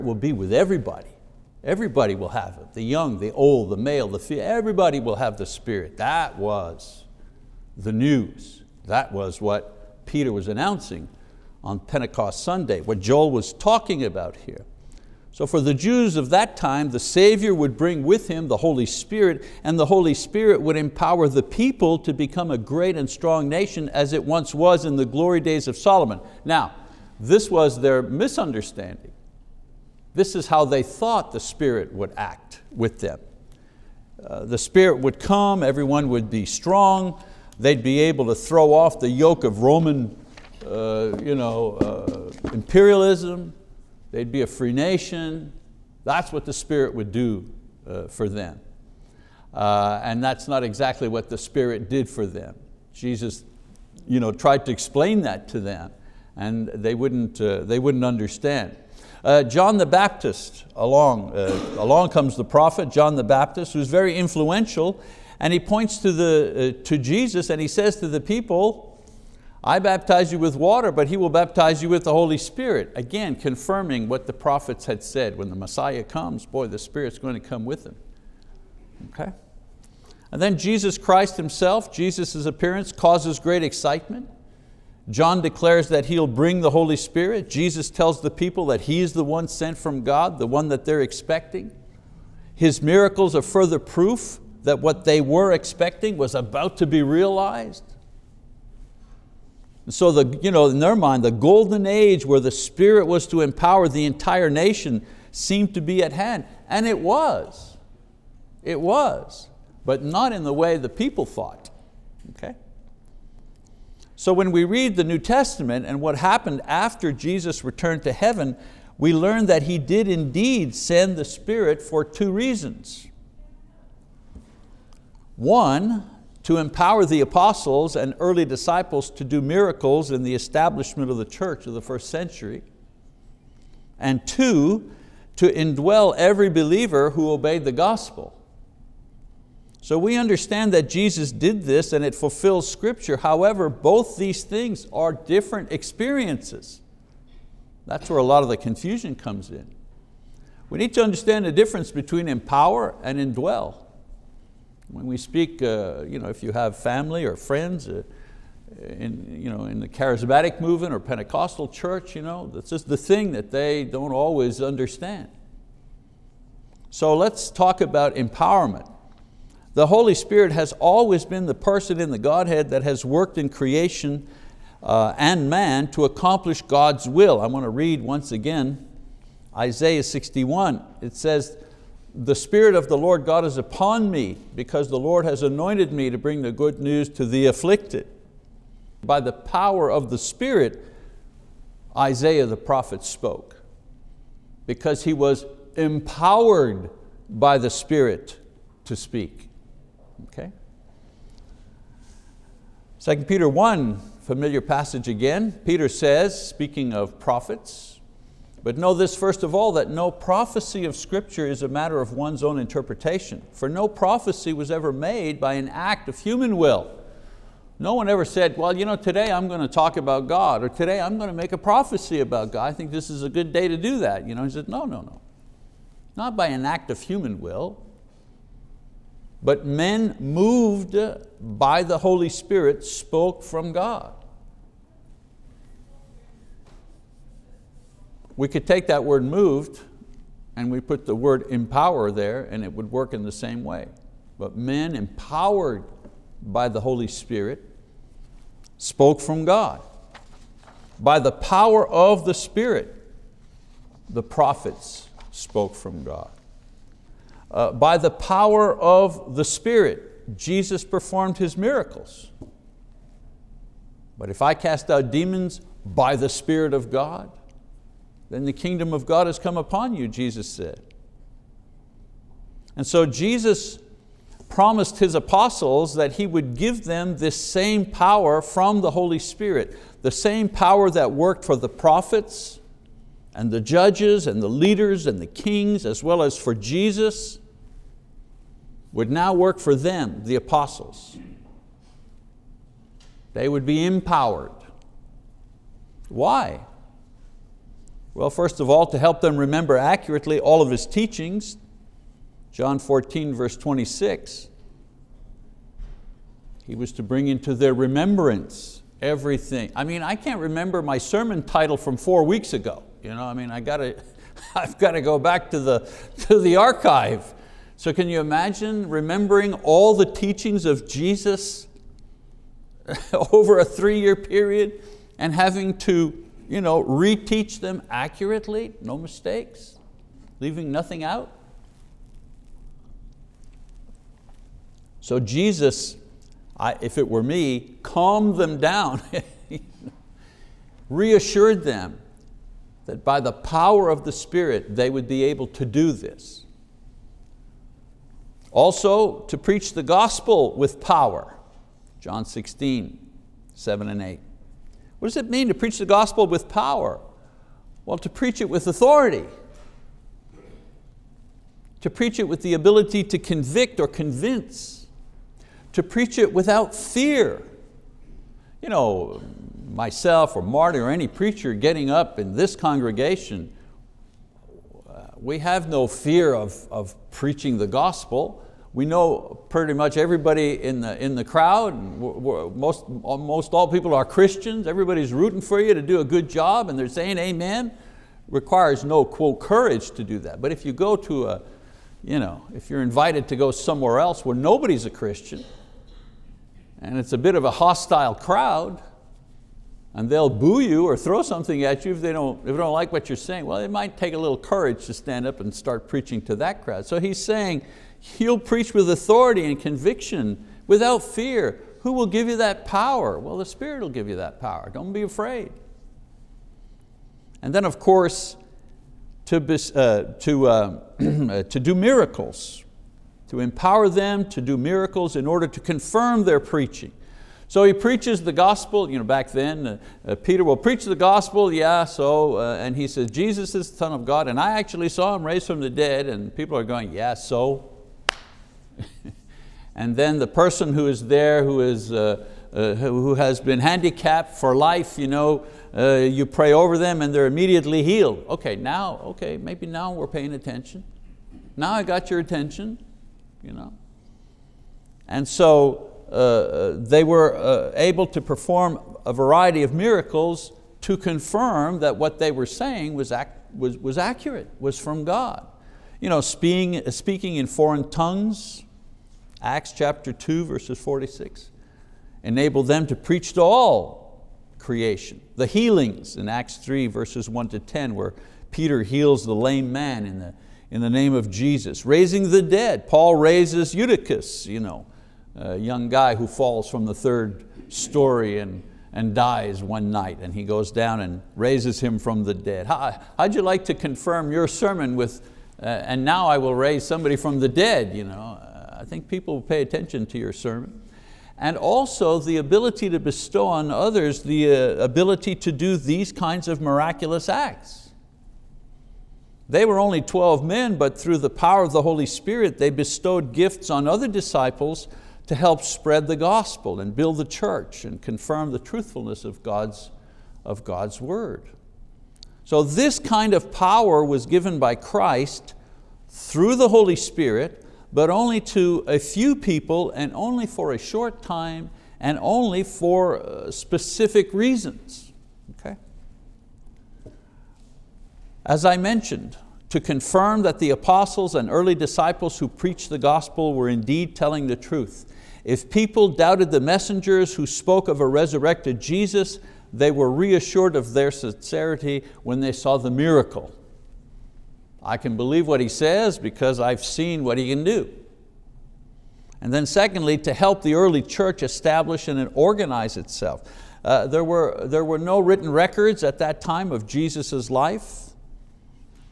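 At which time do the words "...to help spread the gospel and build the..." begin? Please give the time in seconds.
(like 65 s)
515 s.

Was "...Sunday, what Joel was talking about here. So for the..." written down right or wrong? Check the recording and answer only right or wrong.
right.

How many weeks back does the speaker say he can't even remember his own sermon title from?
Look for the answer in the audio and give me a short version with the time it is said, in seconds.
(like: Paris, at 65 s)
4, at 311 s.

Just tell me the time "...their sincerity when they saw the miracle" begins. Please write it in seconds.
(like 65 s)
550 s.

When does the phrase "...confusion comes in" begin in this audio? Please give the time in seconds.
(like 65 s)
148 s.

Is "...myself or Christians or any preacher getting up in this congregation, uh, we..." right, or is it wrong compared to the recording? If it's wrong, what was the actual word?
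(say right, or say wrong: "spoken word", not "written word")
wrong: "Marty", not "Christians".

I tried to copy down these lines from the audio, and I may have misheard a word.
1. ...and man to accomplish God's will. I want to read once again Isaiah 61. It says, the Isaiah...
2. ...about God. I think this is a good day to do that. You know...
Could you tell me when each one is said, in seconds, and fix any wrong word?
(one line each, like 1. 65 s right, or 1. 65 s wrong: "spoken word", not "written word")
1. 175 s wrong: "Spirit", not "Isaiah"
2. 222 s right.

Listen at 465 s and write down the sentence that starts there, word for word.
You know, speaking, speaking in foreign tongues, Acts chapter 2, verses 46.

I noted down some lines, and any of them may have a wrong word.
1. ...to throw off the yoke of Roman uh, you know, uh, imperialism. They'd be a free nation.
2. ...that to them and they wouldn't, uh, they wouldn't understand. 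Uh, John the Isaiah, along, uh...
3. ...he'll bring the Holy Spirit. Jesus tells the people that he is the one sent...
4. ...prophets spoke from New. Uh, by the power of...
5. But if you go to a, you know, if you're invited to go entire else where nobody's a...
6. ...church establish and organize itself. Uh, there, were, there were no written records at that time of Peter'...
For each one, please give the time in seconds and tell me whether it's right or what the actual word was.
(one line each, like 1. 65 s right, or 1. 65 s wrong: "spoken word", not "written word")
1. 38 s right
2. 55 s wrong: "Baptist", not "Isaiah"
3. 86 s right
4. 254 s wrong: "God", not "New"
5. 390 s wrong: "somewhere", not "entire"
6. 561 s wrong: "Jesus", not "Peter".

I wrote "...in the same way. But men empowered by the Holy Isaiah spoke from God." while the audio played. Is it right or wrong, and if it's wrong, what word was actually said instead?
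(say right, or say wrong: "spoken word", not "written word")
wrong: "Spirit", not "Isaiah".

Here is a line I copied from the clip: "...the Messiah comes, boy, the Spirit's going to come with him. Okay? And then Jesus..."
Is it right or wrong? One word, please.
right.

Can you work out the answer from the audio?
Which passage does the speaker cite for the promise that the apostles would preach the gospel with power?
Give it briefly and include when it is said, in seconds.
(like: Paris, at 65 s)
John 16:7-8, at 351 s.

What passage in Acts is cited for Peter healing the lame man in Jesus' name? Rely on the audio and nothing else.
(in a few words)
Acts 3:1-10.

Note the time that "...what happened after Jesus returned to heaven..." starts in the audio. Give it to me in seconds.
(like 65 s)
116 s.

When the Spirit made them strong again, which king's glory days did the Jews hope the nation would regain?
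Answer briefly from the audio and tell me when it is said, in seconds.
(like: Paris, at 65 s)
Solomon, at 25 s.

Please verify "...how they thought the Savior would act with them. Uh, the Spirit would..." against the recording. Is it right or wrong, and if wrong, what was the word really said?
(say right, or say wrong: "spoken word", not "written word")
wrong: "Spirit", not "Savior".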